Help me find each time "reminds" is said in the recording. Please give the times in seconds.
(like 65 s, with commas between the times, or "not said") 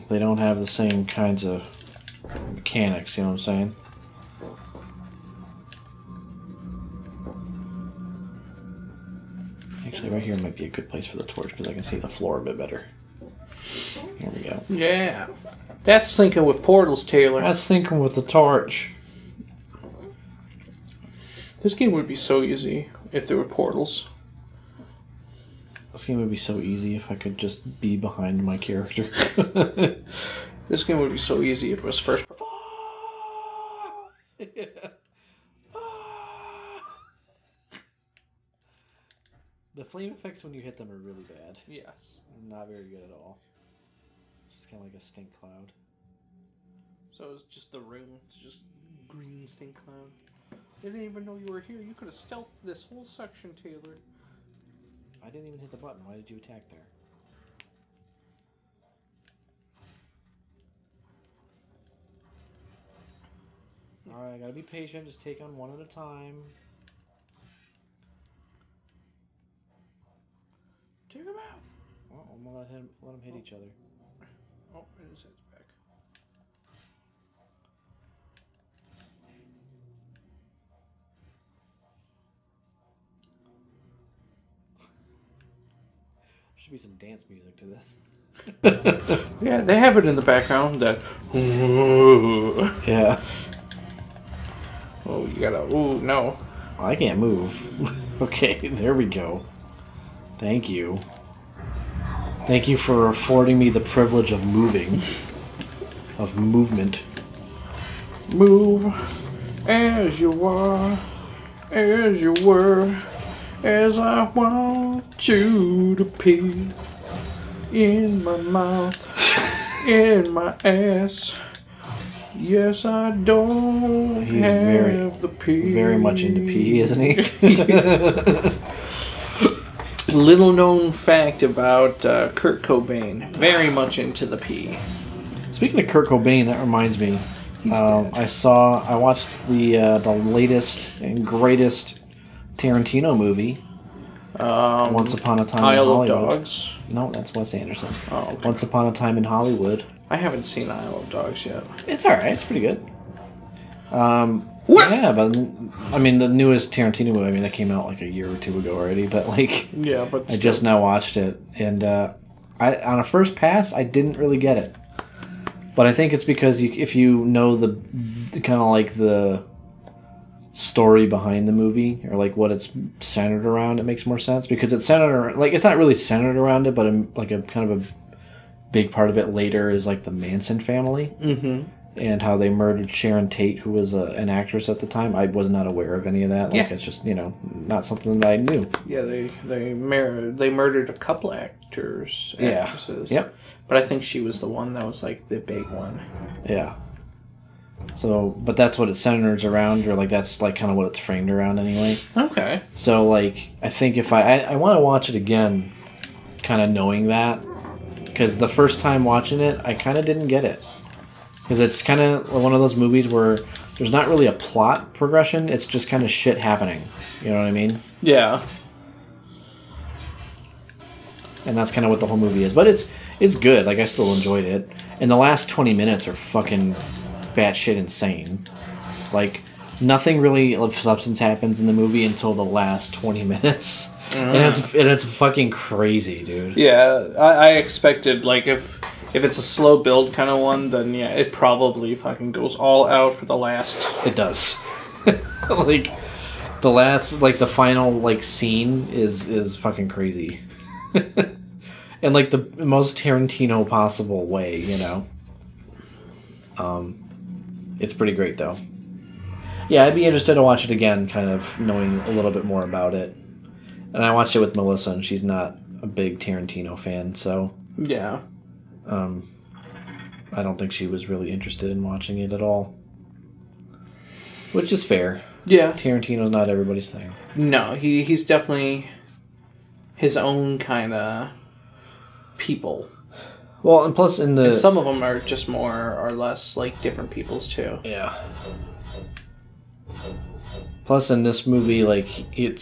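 136 s.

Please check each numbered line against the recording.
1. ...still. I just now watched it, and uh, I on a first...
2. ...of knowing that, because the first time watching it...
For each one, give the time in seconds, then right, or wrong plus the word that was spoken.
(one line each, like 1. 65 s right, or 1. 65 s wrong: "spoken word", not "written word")
1. 160 s right
2. 206 s right.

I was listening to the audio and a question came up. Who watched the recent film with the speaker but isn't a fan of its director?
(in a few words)
Melissa.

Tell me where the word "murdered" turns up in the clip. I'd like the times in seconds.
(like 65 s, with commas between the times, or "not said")
182 s, 190 s.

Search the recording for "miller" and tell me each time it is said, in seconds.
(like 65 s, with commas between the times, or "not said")
not said.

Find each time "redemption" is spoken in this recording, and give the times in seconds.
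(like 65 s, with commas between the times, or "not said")
not said.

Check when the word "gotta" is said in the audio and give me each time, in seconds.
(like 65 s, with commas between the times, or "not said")
64 s, 95 s.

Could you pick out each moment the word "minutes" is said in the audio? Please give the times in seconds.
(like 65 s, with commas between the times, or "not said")
225 s, 233 s.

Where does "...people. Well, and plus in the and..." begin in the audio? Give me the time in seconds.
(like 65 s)
282 s.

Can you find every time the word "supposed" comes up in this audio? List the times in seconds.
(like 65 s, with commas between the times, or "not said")
not said.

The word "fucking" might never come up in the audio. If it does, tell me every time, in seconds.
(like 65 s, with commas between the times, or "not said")
226 s, 235 s, 241 s, 249 s.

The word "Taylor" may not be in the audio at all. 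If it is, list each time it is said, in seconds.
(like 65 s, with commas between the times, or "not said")
17 s, 53 s.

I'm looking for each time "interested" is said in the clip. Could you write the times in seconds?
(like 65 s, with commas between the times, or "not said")
260 s, 271 s.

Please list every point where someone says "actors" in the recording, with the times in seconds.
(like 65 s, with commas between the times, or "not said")
191 s.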